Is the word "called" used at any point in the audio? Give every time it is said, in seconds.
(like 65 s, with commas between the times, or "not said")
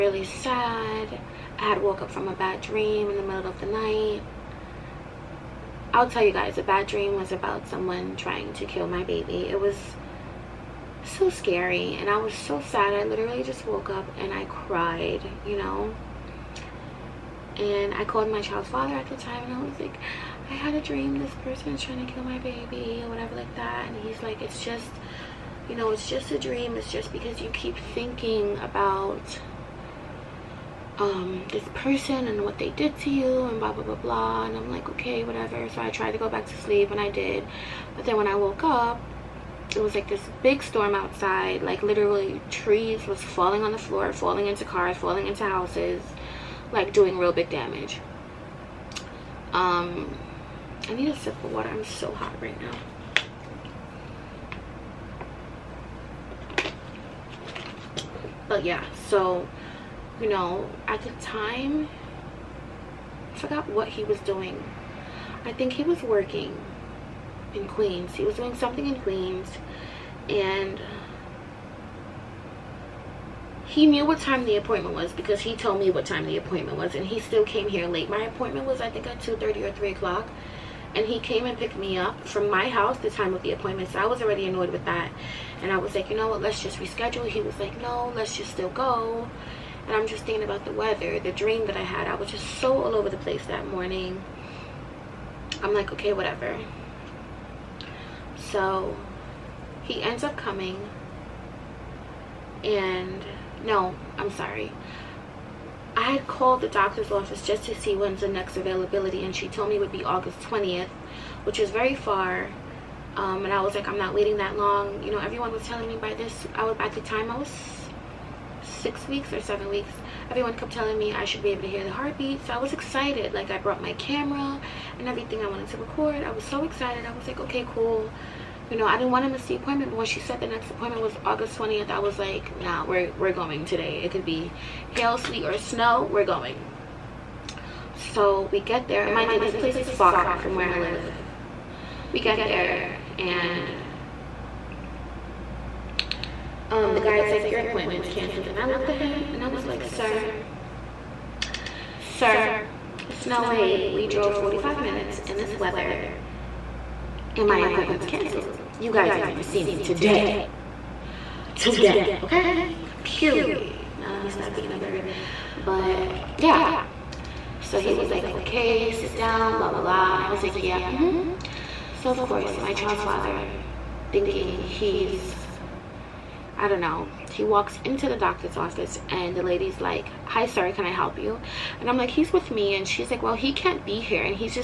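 18 s, 106 s.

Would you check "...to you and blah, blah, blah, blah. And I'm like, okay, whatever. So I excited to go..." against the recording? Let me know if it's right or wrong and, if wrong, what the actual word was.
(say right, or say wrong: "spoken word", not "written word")
wrong: "tried", not "excited".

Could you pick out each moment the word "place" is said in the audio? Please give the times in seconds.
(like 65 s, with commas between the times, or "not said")
93 s, 139 s.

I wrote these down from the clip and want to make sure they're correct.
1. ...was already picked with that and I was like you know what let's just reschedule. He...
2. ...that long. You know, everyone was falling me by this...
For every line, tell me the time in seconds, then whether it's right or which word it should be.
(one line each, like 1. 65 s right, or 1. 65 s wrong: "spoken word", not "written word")
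1. 84 s wrong: "annoyed", not "picked"
2. 114 s wrong: "telling", not "falling".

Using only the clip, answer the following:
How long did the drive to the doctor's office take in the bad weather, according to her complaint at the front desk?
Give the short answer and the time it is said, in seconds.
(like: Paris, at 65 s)
45 minutes, at 154 s.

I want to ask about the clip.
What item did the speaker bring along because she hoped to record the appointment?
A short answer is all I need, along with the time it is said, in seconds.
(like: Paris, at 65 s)
camera, at 123 s.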